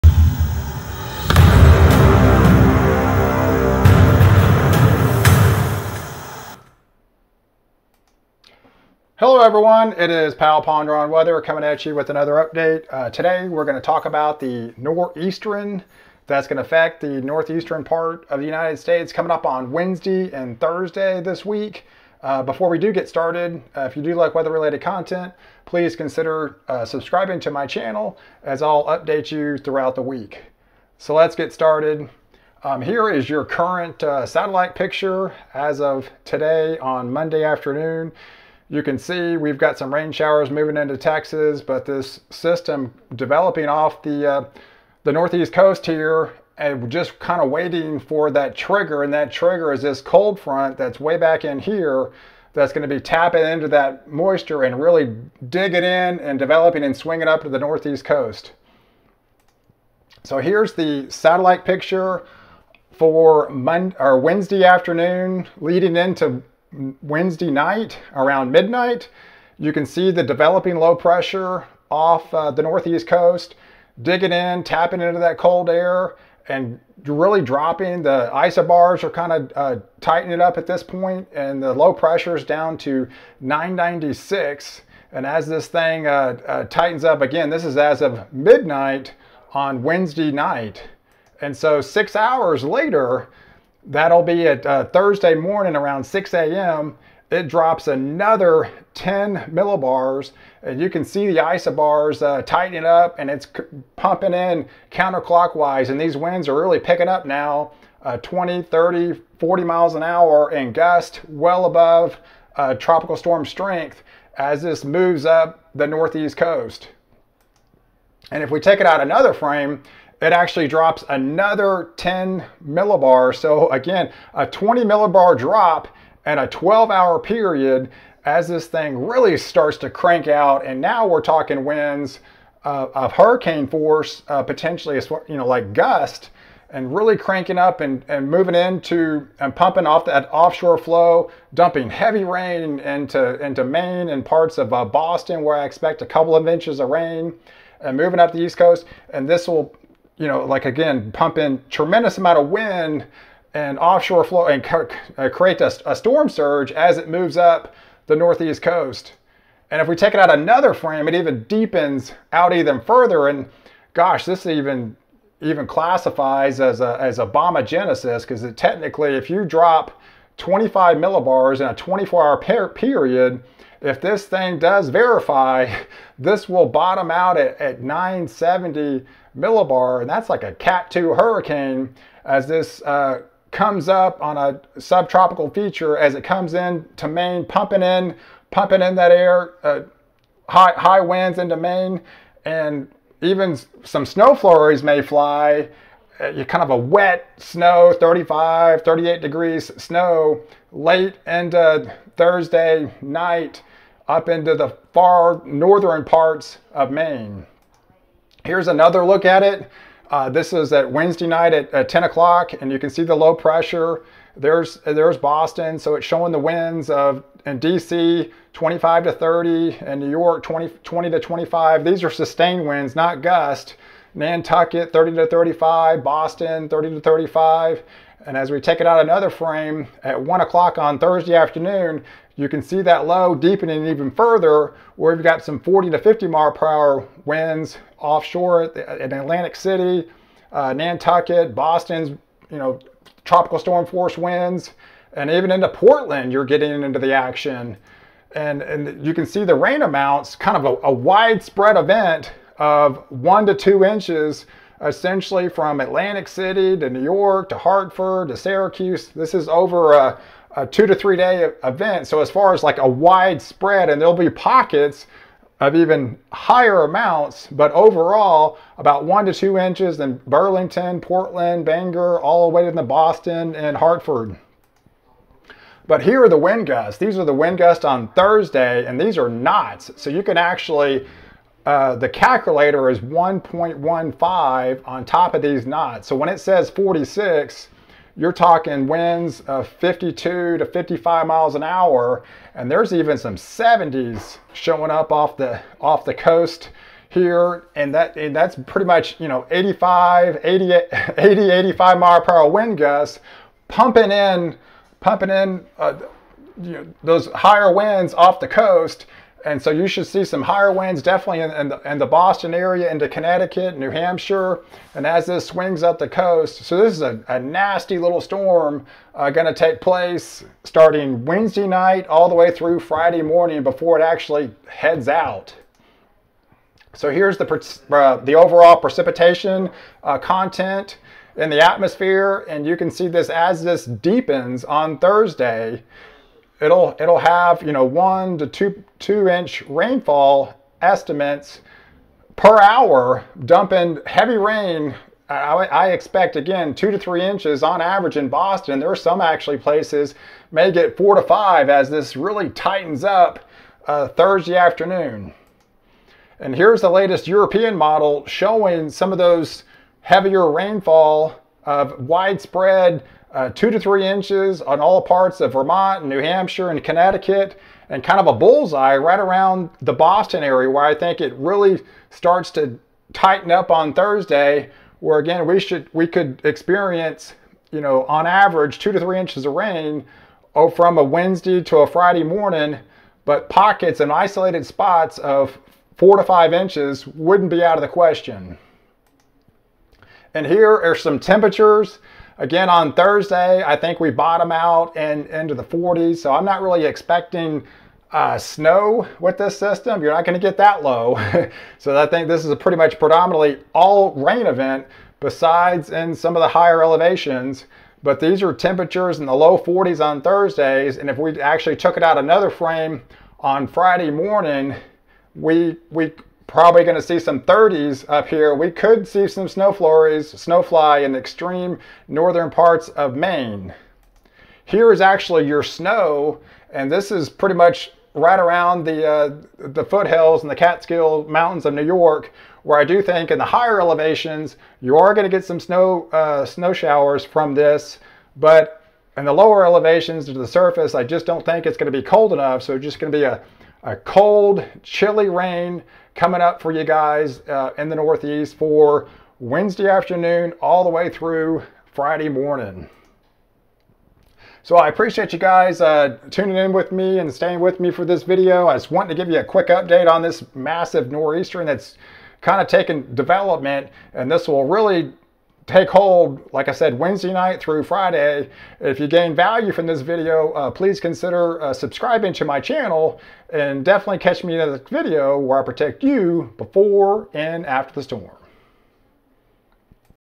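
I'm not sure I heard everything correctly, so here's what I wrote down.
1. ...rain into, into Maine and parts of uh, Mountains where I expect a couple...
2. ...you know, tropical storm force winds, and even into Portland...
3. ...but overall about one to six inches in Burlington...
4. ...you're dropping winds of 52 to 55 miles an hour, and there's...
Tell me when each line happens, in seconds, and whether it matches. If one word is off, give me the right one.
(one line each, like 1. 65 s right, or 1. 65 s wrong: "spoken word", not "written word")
1. 142 s wrong: "Boston", not "Mountains"
2. 242 s right
3. 267 s wrong: "two", not "six"
4. 288 s wrong: "talking", not "dropping".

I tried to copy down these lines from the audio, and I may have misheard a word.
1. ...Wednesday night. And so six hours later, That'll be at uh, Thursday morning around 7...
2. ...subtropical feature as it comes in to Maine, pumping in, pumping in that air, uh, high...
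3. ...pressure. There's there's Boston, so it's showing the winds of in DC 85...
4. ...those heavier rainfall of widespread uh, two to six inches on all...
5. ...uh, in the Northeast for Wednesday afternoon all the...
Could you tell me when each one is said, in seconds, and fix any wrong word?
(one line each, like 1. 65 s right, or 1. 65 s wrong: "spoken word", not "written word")
1. 89 s wrong: "6", not "7"
2. 184 s right
3. 213 s wrong: "25", not "85"
4. 359 s wrong: "three", not "six"
5. 447 s right.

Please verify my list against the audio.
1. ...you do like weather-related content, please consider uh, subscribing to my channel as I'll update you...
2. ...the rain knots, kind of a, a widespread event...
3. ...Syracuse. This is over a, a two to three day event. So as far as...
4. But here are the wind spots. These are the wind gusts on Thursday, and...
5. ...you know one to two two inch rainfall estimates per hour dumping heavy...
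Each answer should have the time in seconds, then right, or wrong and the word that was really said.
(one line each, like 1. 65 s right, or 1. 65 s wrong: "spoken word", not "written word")
1. 23 s right
2. 249 s wrong: "amounts", not "knots"
3. 258 s right
4. 275 s wrong: "gusts", not "spots"
5. 337 s right.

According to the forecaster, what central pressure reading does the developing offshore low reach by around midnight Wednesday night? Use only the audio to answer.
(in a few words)
996.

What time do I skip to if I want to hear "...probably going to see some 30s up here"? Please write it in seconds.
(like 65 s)
416 s.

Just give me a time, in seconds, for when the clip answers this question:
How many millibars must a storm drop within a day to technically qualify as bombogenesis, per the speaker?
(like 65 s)
170 s.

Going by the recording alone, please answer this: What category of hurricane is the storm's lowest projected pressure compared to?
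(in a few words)
Cat 2.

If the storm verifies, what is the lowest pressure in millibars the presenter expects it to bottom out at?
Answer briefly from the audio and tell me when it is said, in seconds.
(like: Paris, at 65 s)
970 millibar, at 177 s.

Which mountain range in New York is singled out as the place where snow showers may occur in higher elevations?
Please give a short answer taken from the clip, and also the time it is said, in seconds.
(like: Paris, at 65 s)
Catskill Mountains, at 430 s.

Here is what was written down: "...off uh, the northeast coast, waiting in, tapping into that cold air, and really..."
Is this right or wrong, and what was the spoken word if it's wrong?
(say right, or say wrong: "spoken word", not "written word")
wrong: "digging", not "waiting".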